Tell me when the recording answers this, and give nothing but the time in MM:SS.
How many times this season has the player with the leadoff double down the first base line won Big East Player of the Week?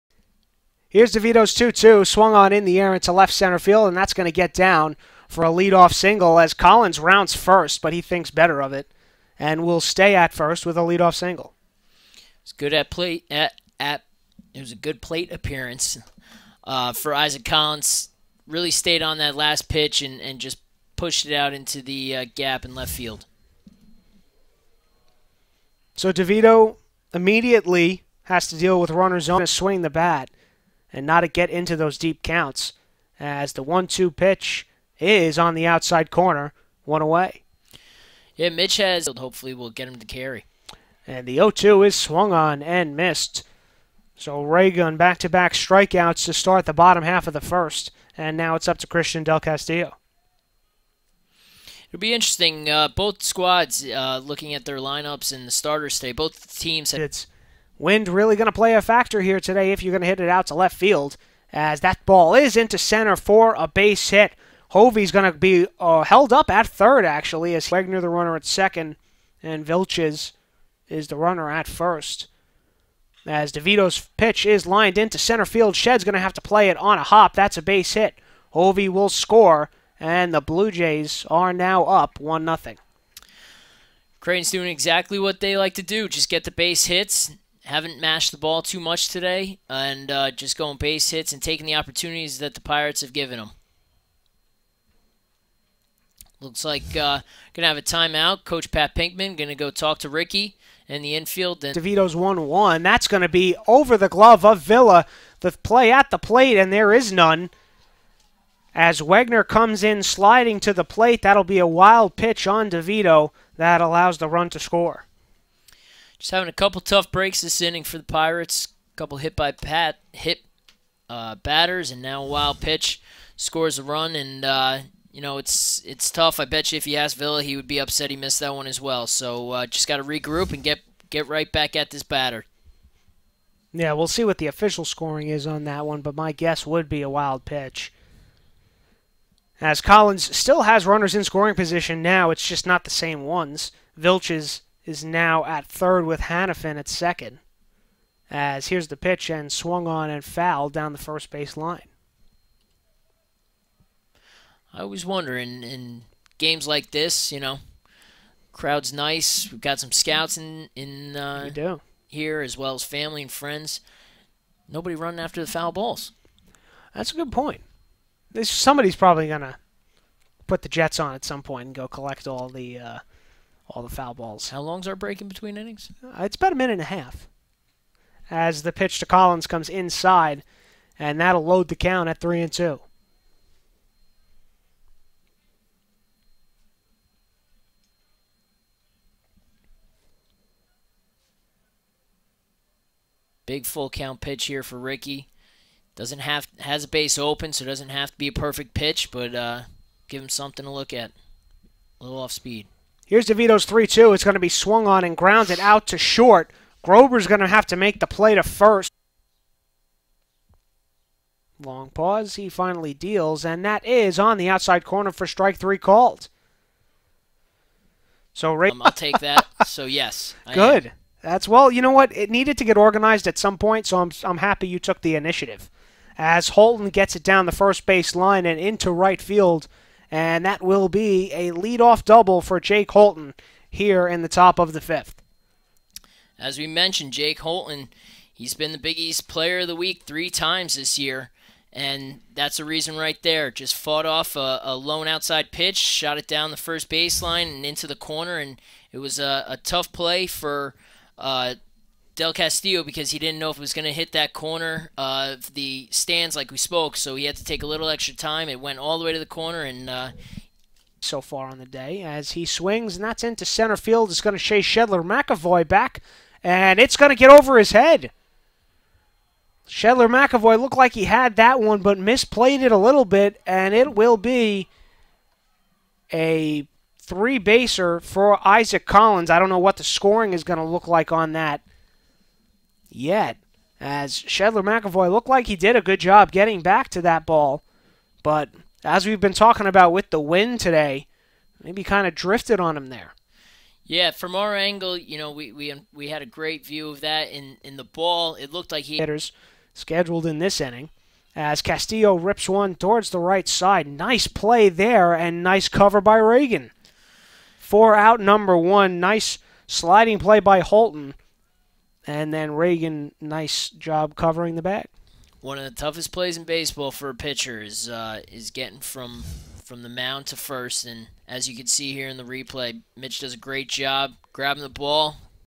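04:00.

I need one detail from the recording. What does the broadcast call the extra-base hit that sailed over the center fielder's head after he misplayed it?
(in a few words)
three baser.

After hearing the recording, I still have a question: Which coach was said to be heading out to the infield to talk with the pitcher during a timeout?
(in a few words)
Pat Pinkman.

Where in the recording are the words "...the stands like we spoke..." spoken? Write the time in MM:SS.
04:15.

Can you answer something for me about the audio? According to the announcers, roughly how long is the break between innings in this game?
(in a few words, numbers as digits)
a minute and a half.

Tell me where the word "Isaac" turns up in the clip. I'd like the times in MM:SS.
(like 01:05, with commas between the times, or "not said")
00:17, 04:38.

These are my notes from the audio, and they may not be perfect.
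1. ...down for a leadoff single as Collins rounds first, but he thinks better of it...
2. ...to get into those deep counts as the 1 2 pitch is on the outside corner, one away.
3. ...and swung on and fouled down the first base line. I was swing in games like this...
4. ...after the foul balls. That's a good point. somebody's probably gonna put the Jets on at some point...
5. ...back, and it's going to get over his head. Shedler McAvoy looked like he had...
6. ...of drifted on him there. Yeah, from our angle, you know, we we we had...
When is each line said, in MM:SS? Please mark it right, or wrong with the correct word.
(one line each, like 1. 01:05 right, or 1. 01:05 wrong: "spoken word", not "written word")
1. 00:04 right
2. 00:31 right
3. 02:29 wrong: "wondering", not "swing"
4. 02:45 right
5. 04:25 right
6. 04:52 right.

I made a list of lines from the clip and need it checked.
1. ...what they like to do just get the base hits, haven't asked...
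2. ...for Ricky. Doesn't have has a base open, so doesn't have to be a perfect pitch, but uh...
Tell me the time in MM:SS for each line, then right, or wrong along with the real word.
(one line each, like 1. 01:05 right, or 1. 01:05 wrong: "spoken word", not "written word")
1. 01:25 wrong: "mashed", not "asked"
2. 03:14 right.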